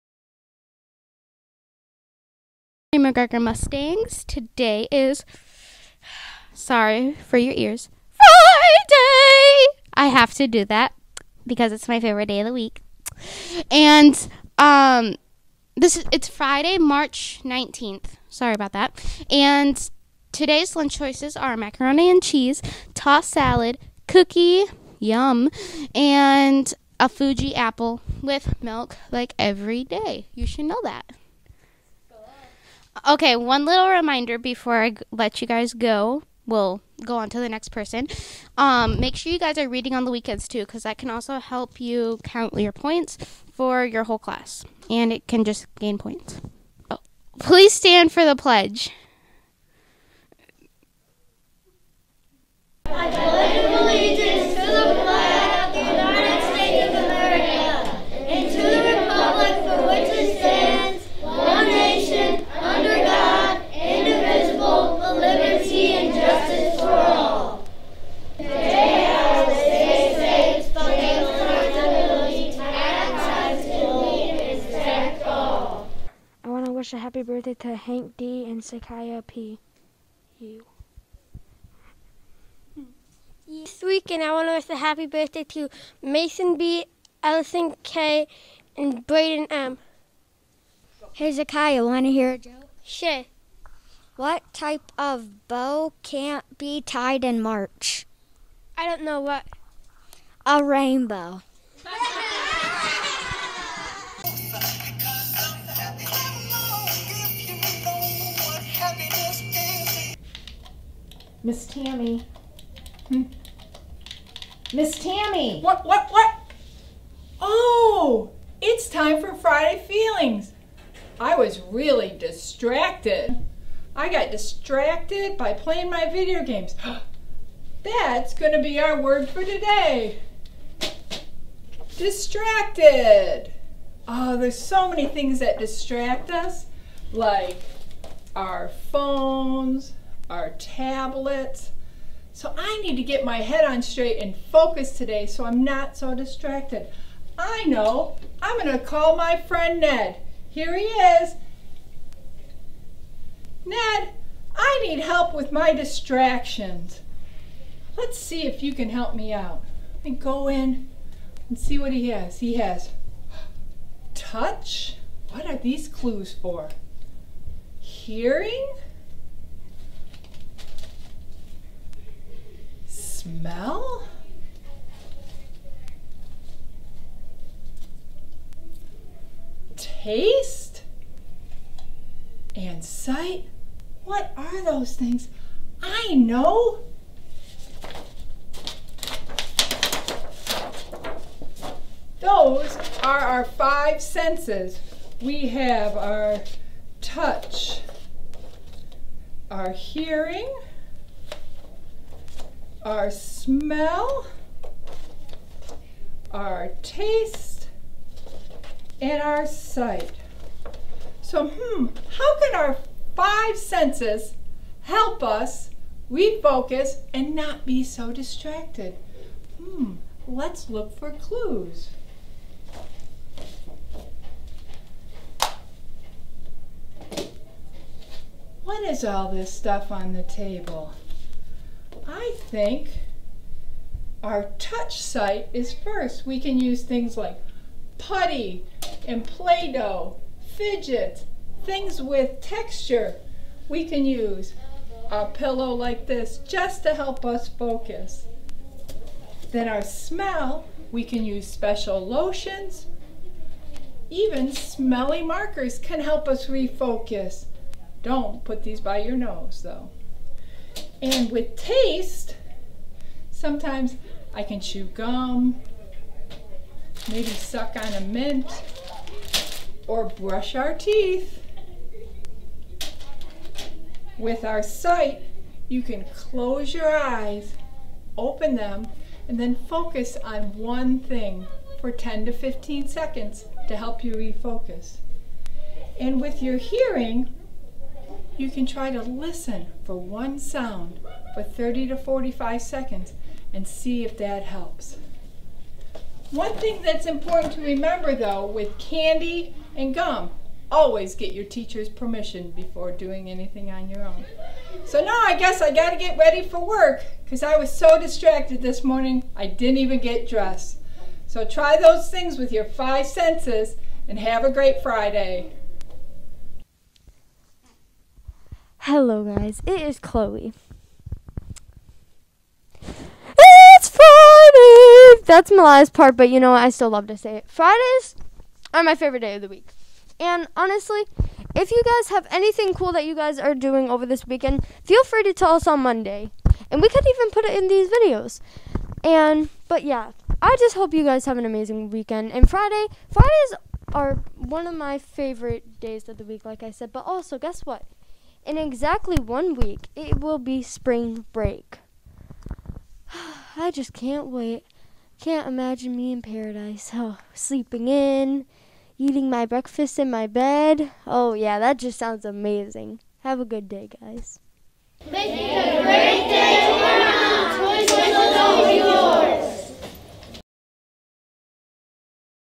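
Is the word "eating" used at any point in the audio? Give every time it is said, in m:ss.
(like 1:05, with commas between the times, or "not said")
5:58.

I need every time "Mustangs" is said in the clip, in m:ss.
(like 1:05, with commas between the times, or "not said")
0:03.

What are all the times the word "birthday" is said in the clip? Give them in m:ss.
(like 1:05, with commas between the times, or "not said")
1:17, 1:25.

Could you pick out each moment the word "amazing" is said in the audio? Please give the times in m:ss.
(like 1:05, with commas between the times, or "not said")
5:41, 6:02.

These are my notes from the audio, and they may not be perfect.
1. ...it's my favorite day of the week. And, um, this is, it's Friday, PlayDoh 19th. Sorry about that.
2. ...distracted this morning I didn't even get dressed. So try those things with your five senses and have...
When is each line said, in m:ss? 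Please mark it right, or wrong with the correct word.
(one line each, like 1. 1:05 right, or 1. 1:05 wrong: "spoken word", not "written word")
1. 0:11 wrong: "March", not "PlayDoh"
2. 5:08 right.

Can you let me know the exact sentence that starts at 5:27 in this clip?
Fridays are my favorite day of the week.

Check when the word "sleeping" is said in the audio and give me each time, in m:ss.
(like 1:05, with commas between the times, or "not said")
5:57.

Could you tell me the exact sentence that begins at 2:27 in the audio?
I know, I'm gonna call my friend Ned.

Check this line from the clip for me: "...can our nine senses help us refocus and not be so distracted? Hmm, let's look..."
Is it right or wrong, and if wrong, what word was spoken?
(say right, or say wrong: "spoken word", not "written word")
wrong: "five", not "nine".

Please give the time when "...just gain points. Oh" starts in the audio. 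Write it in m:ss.
0:45.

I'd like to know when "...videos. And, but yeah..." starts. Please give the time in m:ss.
5:37.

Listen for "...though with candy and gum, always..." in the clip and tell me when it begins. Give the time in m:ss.
4:58.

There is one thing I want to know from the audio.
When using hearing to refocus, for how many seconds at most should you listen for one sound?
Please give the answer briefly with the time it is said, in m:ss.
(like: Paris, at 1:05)
45, at 4:51.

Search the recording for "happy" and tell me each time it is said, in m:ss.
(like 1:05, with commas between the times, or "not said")
1:17, 1:24.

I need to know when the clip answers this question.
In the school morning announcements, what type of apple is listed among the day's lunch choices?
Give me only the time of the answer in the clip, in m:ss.
0:27.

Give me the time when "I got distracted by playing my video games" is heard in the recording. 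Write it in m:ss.
2:03.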